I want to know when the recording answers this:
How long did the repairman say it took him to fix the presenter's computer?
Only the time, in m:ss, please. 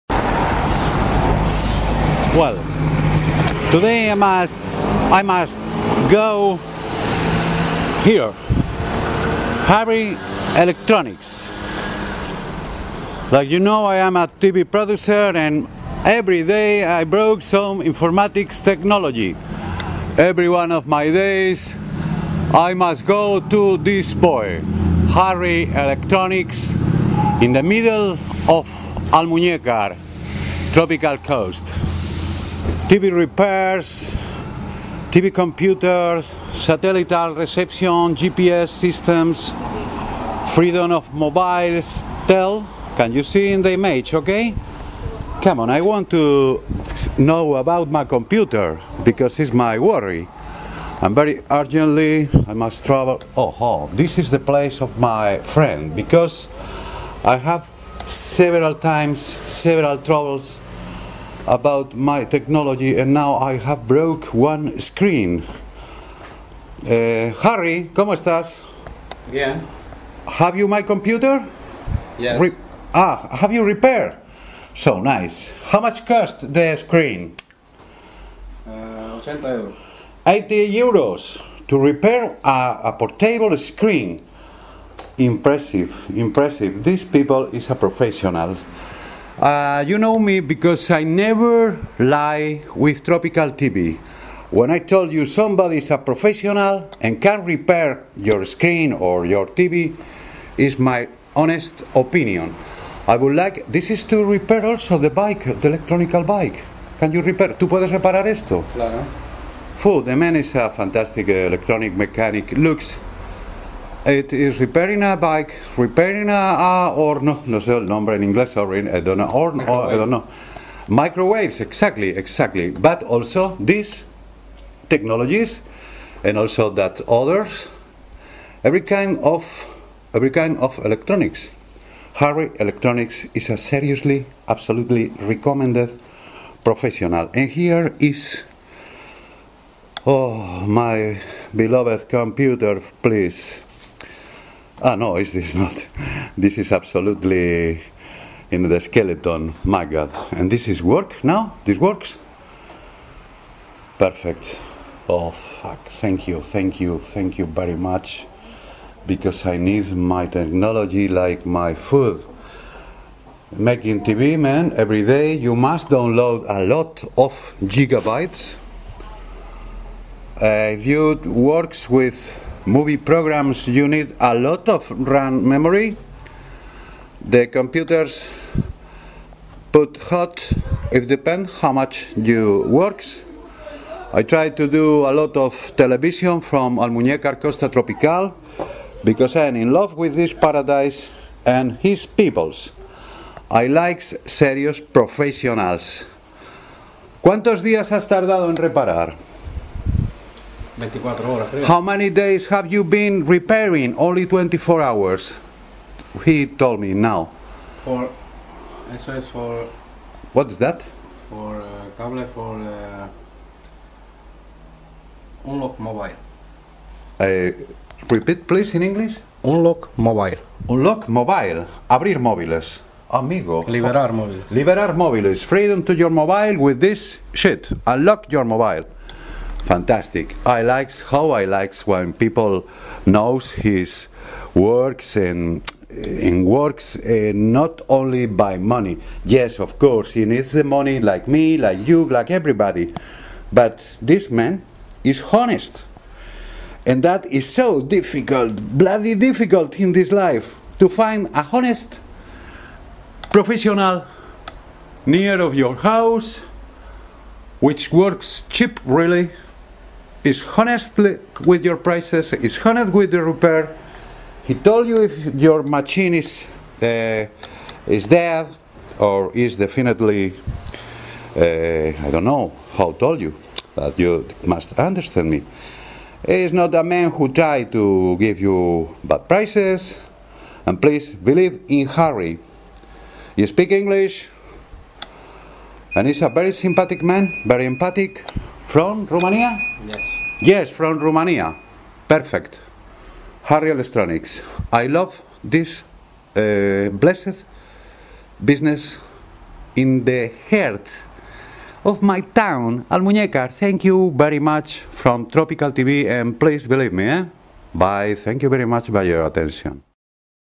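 3:24.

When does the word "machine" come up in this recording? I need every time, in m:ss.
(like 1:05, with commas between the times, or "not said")
4:25.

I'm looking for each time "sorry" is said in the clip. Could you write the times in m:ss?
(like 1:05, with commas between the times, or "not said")
1:58.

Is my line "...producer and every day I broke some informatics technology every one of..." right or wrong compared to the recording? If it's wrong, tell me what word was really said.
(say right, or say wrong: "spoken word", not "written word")
right.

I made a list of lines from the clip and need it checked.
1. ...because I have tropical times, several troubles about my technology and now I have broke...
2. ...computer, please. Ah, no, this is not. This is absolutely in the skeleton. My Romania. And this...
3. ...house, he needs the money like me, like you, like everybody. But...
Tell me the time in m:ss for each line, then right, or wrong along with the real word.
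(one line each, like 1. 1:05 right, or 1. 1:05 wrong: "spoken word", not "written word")
1. 0:55 wrong: "several", not "tropical"
2. 2:22 wrong: "God", not "Romania"
3. 3:59 wrong: "course", not "house".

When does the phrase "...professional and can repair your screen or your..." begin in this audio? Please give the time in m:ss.
1:35.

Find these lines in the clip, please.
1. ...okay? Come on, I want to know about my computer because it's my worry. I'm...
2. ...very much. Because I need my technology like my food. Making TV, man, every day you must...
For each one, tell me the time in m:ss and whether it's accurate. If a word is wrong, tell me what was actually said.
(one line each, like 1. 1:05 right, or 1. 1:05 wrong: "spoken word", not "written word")
1. 0:44 right
2. 2:37 right.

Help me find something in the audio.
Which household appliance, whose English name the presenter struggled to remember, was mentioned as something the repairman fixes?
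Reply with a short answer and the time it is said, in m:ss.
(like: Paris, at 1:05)
Microwaves, at 2:00.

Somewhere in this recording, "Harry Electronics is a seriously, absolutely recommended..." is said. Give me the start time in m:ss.
2:12.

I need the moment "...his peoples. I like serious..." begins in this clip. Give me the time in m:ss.
3:11.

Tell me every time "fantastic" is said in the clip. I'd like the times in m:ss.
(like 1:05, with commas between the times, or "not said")
1:50, 3:49.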